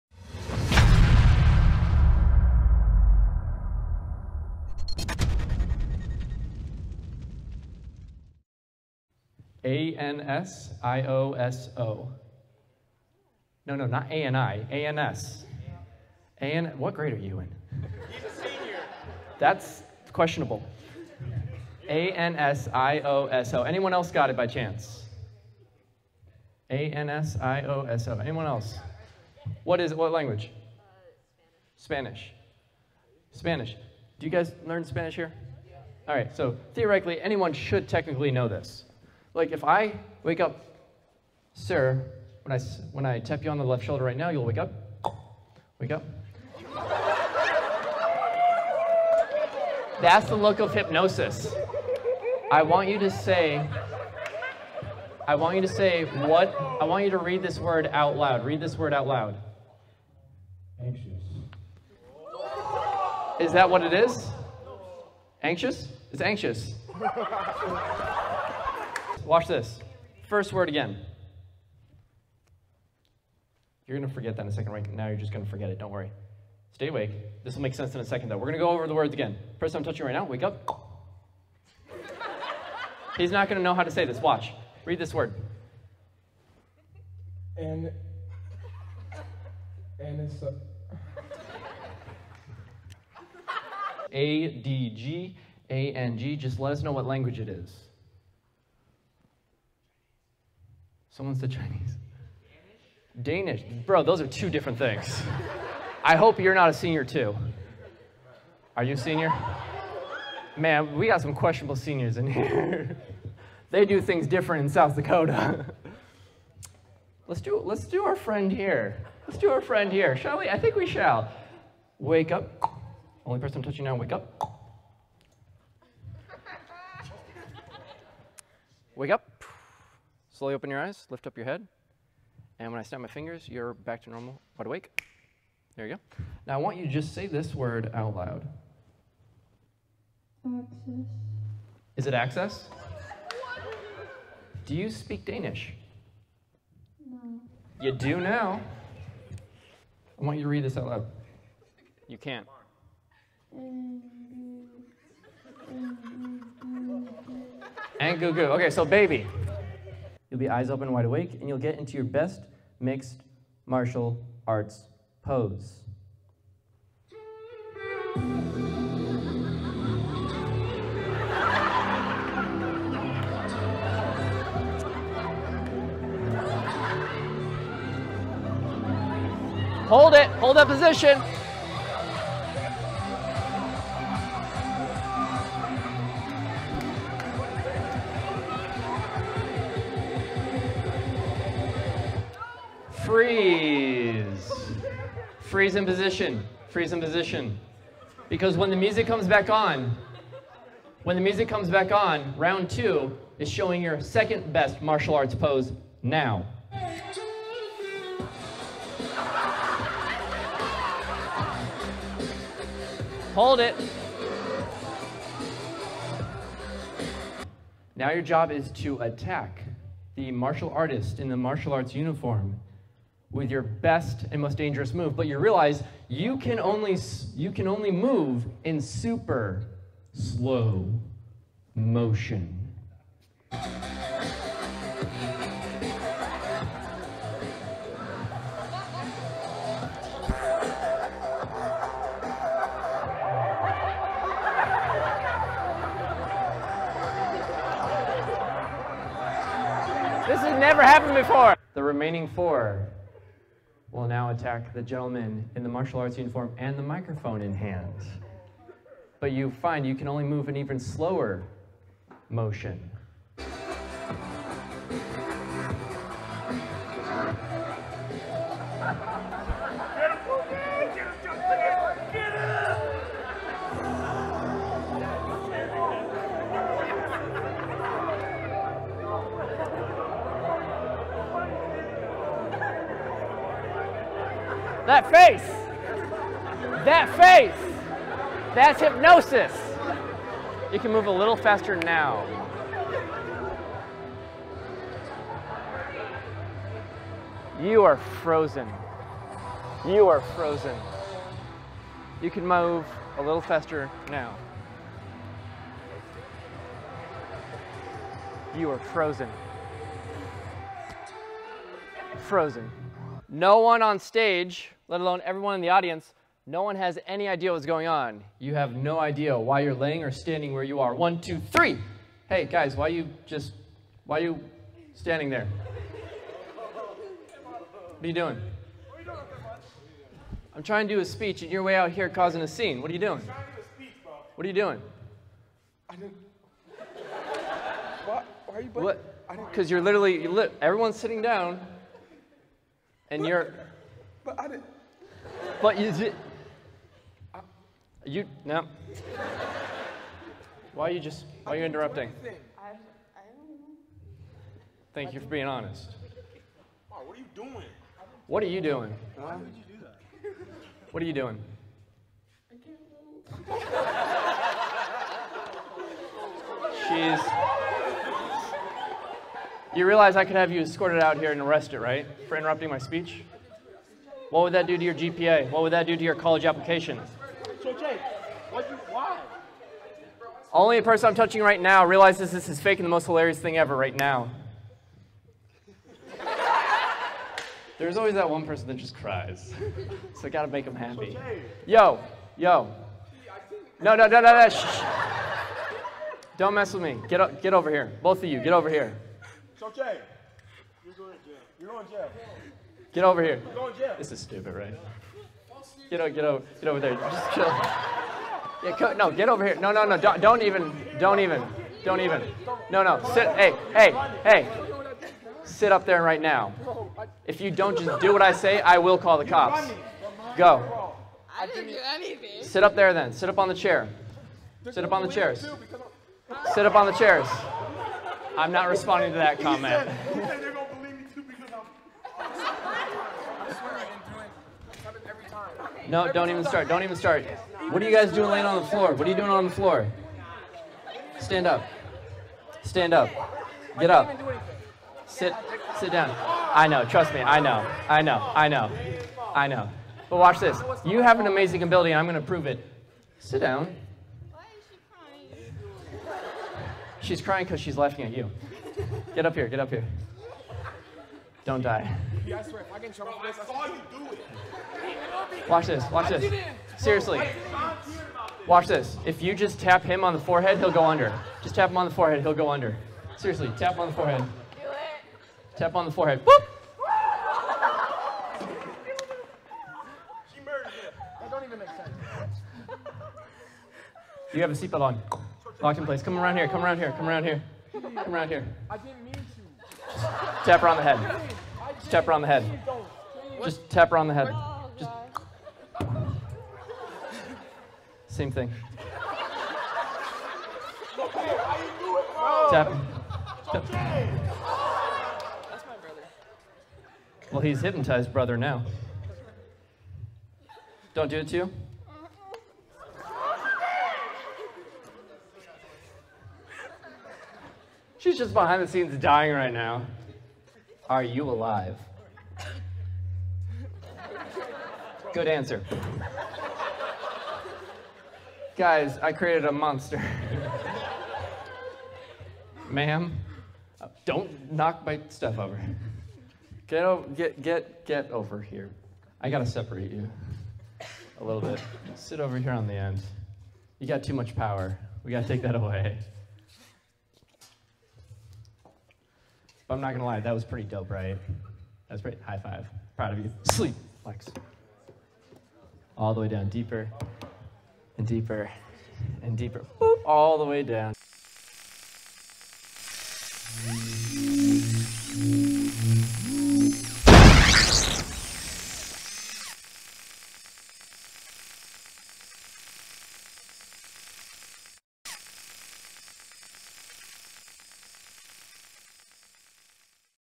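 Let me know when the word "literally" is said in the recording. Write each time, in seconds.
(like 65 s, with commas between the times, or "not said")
339 s.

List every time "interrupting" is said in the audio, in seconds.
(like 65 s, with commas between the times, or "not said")
351 s, 372 s.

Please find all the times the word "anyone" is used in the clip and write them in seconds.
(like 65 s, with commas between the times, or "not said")
23 s, 28 s, 37 s.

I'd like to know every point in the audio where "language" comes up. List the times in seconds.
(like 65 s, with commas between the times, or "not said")
30 s, 97 s.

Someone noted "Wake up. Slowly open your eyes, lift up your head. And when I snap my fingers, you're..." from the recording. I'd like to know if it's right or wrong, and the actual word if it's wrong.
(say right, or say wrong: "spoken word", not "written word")
right.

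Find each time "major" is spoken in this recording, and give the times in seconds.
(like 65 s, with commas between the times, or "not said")
not said.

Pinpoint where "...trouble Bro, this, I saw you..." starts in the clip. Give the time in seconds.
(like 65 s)
462 s.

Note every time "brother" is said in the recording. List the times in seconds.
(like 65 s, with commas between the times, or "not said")
508 s.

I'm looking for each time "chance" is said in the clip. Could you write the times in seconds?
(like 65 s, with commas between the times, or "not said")
24 s.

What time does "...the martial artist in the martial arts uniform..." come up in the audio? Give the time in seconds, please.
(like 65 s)
220 s.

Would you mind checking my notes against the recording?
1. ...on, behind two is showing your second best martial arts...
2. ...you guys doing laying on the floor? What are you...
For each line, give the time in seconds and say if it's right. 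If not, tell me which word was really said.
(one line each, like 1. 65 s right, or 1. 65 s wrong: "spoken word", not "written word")
1. 201 s wrong: "round", not "behind"
2. 437 s right.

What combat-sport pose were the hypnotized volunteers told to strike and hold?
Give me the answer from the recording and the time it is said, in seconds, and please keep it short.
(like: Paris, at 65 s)
Mixed martial arts pose, at 162 s.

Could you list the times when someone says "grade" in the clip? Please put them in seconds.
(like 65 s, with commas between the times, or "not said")
16 s.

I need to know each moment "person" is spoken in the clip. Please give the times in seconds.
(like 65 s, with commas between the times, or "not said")
79 s, 123 s, 380 s, 388 s.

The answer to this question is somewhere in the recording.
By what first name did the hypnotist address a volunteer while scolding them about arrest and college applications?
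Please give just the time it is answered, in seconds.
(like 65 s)
377 s.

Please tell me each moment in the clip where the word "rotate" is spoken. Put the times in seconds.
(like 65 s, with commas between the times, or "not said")
not said.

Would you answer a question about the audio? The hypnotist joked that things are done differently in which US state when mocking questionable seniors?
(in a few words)
South Dakota.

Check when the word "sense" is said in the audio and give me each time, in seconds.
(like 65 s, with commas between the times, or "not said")
77 s, 481 s.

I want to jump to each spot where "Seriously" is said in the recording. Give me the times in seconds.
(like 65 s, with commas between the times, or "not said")
466 s, 473 s.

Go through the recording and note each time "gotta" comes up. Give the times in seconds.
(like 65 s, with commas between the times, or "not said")
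390 s, 539 s, 545 s.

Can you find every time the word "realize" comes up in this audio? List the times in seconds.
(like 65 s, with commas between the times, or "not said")
225 s, 369 s, 381 s.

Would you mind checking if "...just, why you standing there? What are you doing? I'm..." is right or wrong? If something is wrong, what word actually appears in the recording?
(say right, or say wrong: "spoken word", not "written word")
right.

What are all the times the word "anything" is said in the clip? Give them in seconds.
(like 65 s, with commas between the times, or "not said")
421 s.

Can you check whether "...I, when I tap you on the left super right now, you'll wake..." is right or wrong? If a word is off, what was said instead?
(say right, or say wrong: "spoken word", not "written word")
wrong: "shoulder", not "super".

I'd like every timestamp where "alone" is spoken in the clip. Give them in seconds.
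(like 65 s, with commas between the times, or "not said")
314 s.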